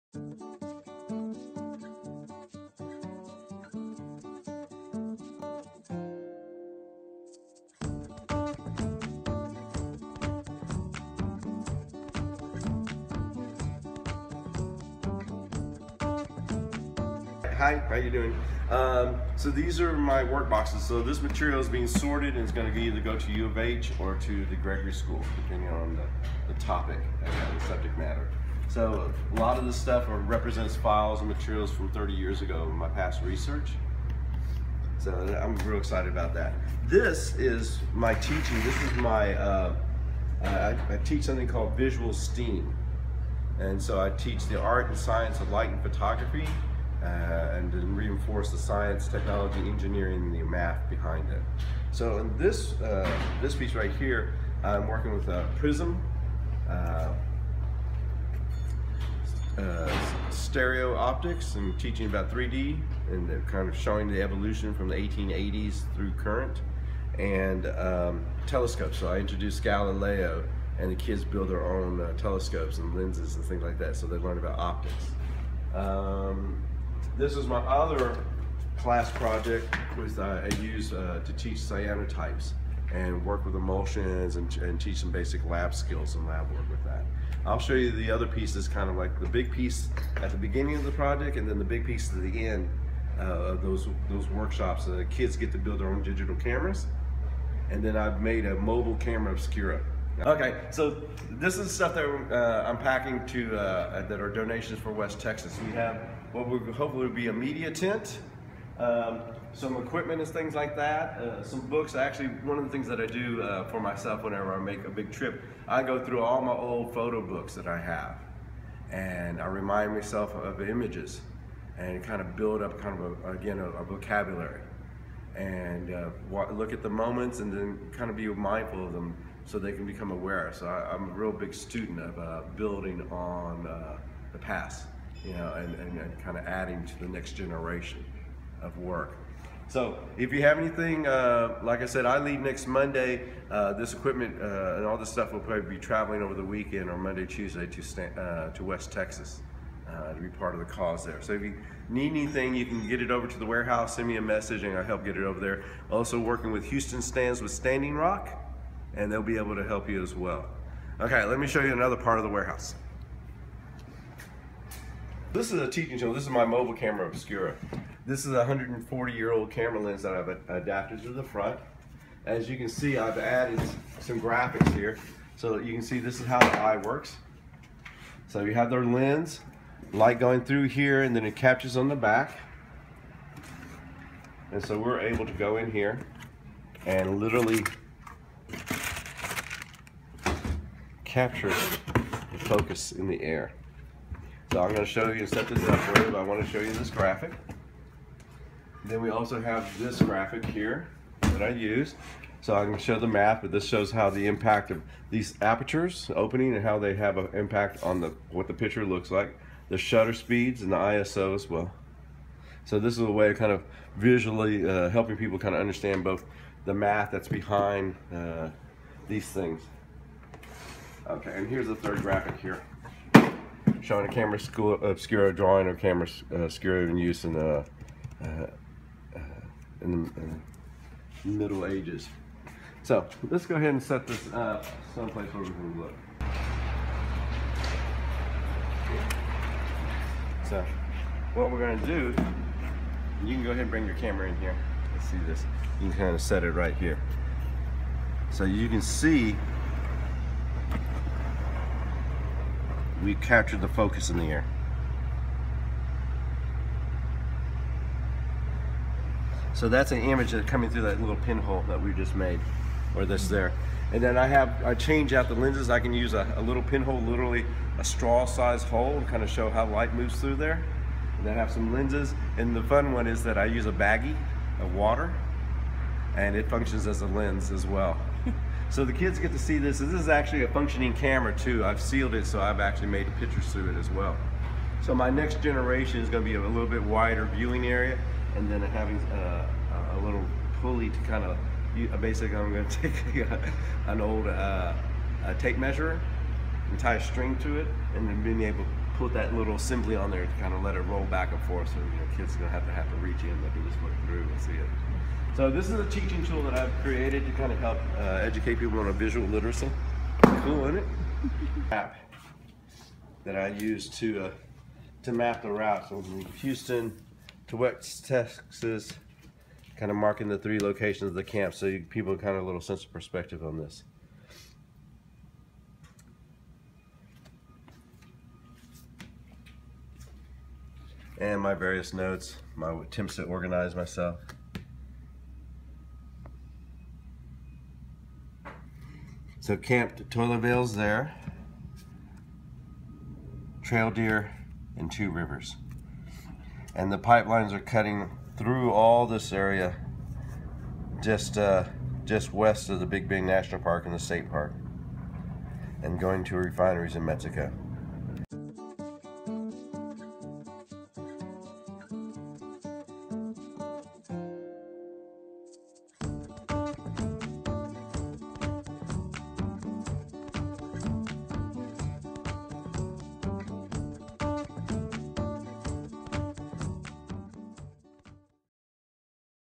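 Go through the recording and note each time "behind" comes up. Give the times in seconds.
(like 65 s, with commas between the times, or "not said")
50 s, 217 s.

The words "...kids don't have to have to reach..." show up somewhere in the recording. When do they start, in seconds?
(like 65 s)
302 s.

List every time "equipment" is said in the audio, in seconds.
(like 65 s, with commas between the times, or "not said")
109 s, 143 s.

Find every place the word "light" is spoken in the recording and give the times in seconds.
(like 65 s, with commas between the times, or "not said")
45 s, 179 s, 269 s.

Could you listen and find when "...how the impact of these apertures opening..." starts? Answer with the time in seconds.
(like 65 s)
203 s.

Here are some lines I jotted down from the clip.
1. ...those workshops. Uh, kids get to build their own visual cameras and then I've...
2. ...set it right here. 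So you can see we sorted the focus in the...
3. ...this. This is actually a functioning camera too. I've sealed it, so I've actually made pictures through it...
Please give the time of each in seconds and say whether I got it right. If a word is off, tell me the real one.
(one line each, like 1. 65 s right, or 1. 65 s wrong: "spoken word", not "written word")
1. 94 s wrong: "digital", not "visual"
2. 246 s wrong: "captured", not "sorted"
3. 279 s right.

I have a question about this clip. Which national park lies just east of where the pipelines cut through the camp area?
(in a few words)
Big Bend National Park.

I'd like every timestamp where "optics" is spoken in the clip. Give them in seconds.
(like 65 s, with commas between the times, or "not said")
60 s, 74 s.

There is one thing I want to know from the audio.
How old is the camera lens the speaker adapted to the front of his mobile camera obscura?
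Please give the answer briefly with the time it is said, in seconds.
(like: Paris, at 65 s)
140 years, at 168 s.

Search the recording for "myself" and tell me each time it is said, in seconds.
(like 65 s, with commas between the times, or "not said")
113 s, 119 s, 333 s.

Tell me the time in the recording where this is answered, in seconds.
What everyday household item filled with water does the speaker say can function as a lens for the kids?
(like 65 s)
273 s.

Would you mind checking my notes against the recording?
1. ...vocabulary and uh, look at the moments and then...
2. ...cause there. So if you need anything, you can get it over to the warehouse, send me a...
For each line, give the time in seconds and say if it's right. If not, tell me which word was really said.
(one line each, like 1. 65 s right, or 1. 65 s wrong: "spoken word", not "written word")
1. 123 s right
2. 150 s right.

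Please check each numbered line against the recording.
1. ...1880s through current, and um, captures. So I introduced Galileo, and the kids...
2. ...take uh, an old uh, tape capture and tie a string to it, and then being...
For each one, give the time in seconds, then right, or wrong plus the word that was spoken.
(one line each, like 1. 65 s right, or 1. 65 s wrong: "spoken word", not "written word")
1. 64 s wrong: "telescopes", not "captures"
2. 292 s wrong: "measure", not "capture".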